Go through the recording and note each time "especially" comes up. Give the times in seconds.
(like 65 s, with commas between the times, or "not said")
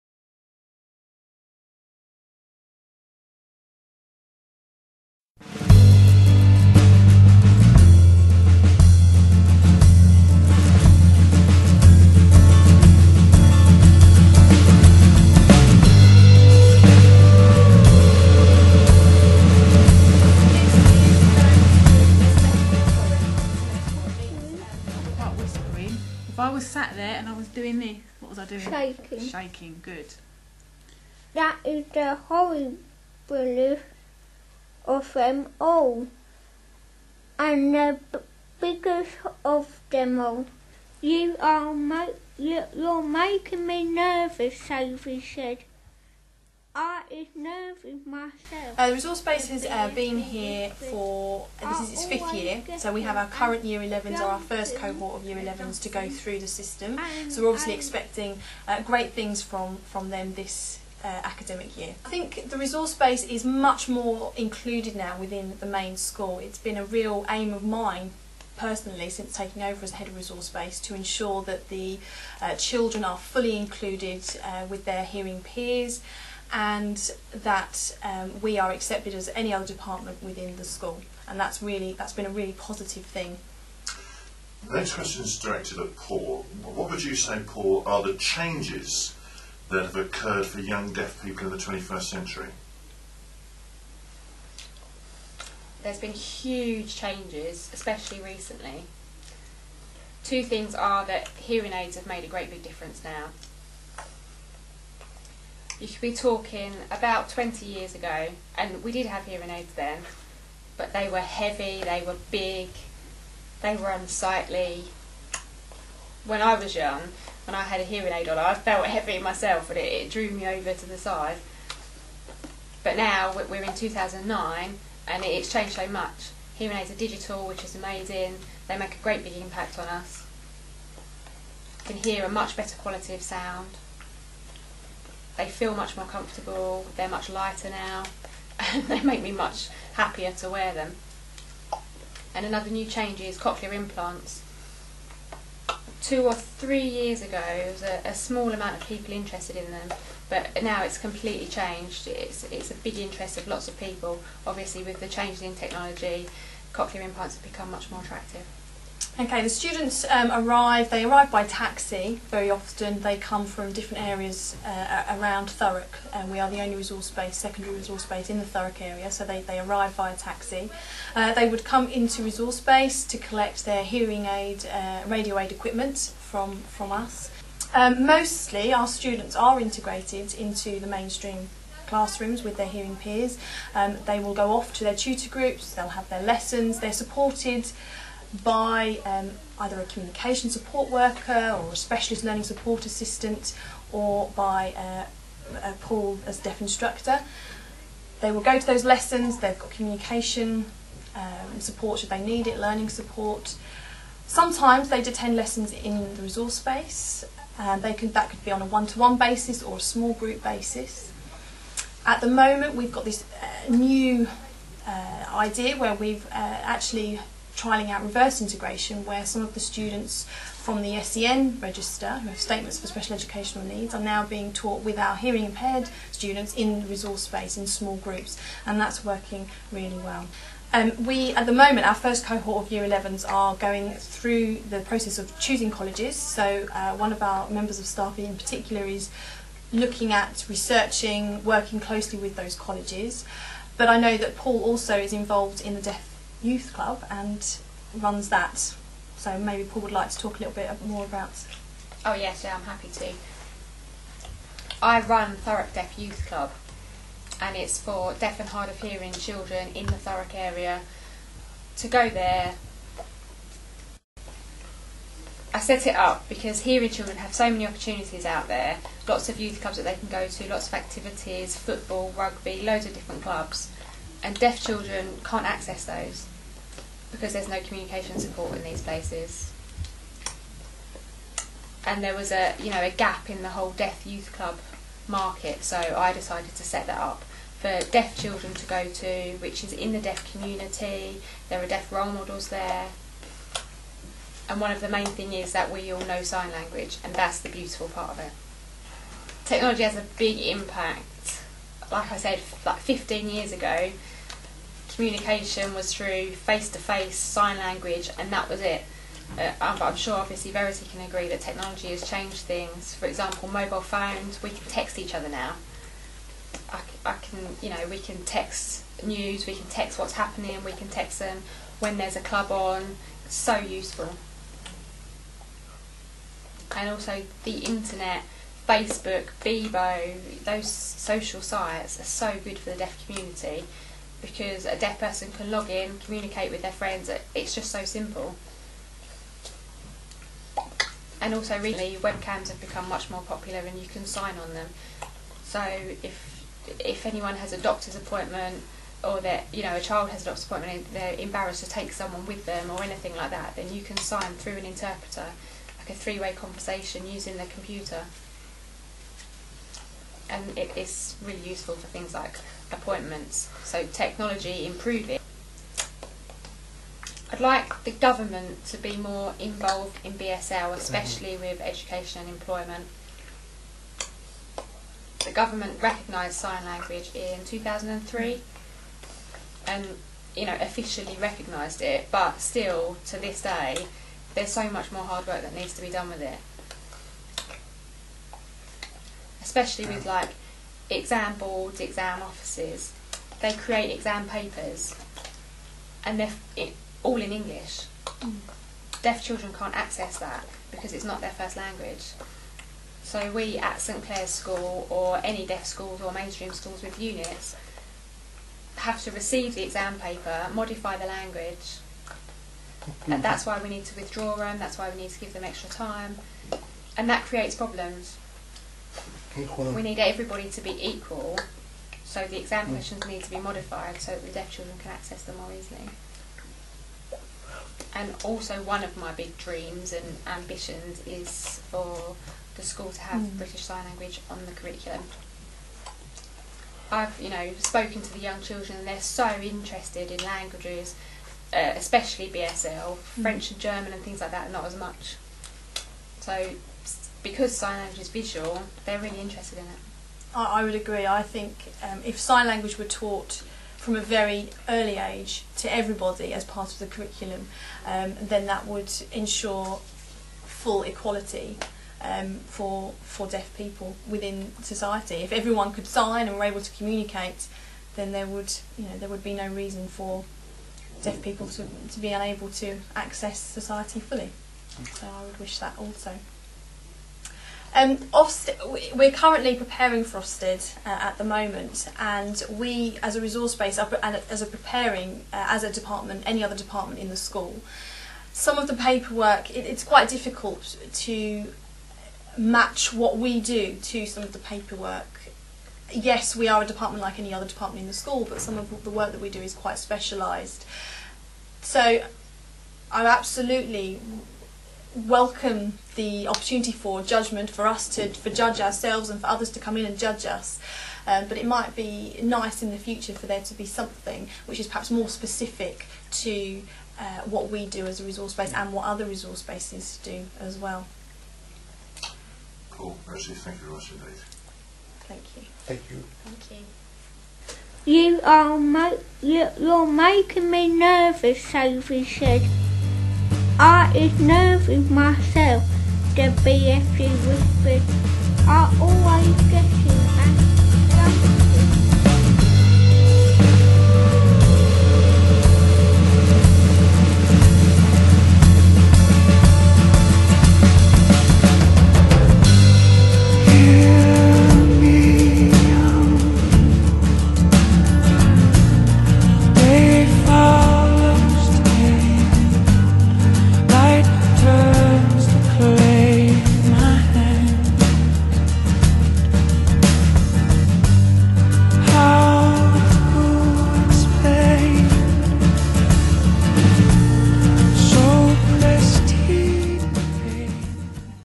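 97 s, 370 s, 389 s, 441 s.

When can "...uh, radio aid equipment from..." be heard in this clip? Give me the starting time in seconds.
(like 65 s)
174 s.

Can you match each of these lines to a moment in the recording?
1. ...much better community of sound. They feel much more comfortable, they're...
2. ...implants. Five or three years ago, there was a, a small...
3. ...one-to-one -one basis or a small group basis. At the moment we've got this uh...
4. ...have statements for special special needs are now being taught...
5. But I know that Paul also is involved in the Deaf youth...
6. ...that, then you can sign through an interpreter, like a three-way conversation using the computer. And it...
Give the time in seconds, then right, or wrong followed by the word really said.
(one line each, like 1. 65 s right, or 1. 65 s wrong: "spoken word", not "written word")
1. 132 s wrong: "quality", not "community"
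2. 143 s wrong: "Two", not "Five"
3. 208 s right
4. 222 s wrong: "educational", not "special"
5. 243 s right
6. 353 s right.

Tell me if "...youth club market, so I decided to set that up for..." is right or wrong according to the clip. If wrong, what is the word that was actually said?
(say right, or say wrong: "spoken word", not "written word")
right.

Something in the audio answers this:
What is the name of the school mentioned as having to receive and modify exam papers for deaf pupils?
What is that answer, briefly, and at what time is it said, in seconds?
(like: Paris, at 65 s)
St Clere's School, at 403 s.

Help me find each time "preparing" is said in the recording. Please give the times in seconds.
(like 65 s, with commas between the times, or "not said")
479 s, 484 s.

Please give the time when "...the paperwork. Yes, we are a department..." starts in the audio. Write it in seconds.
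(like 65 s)
494 s.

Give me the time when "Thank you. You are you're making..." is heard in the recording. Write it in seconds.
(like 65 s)
526 s.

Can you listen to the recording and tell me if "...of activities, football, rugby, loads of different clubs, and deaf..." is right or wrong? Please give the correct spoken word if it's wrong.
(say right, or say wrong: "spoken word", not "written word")
right.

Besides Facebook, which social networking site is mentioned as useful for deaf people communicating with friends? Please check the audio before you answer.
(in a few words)
Bebo.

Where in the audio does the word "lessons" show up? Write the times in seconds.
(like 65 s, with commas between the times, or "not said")
186 s, 198 s, 205 s.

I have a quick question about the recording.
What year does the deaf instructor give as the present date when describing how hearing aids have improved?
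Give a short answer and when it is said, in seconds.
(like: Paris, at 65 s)
2009, at 123 s.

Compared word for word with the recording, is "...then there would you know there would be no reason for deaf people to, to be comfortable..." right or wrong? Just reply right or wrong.
wrong.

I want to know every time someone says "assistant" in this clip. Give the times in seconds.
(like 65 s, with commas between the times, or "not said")
192 s.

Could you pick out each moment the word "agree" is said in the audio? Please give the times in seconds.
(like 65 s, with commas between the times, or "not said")
311 s, 450 s.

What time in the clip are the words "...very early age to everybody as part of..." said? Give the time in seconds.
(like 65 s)
454 s.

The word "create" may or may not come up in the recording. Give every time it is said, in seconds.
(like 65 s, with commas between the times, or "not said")
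393 s, 417 s.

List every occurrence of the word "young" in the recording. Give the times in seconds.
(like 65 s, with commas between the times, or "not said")
90 s, 116 s, 438 s.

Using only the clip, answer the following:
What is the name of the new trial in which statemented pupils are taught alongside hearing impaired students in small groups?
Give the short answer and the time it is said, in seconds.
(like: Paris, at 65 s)
Reverse integration, at 218 s.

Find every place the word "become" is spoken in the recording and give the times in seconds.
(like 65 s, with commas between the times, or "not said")
157 s, 342 s.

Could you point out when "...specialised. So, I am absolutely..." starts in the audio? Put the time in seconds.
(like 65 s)
499 s.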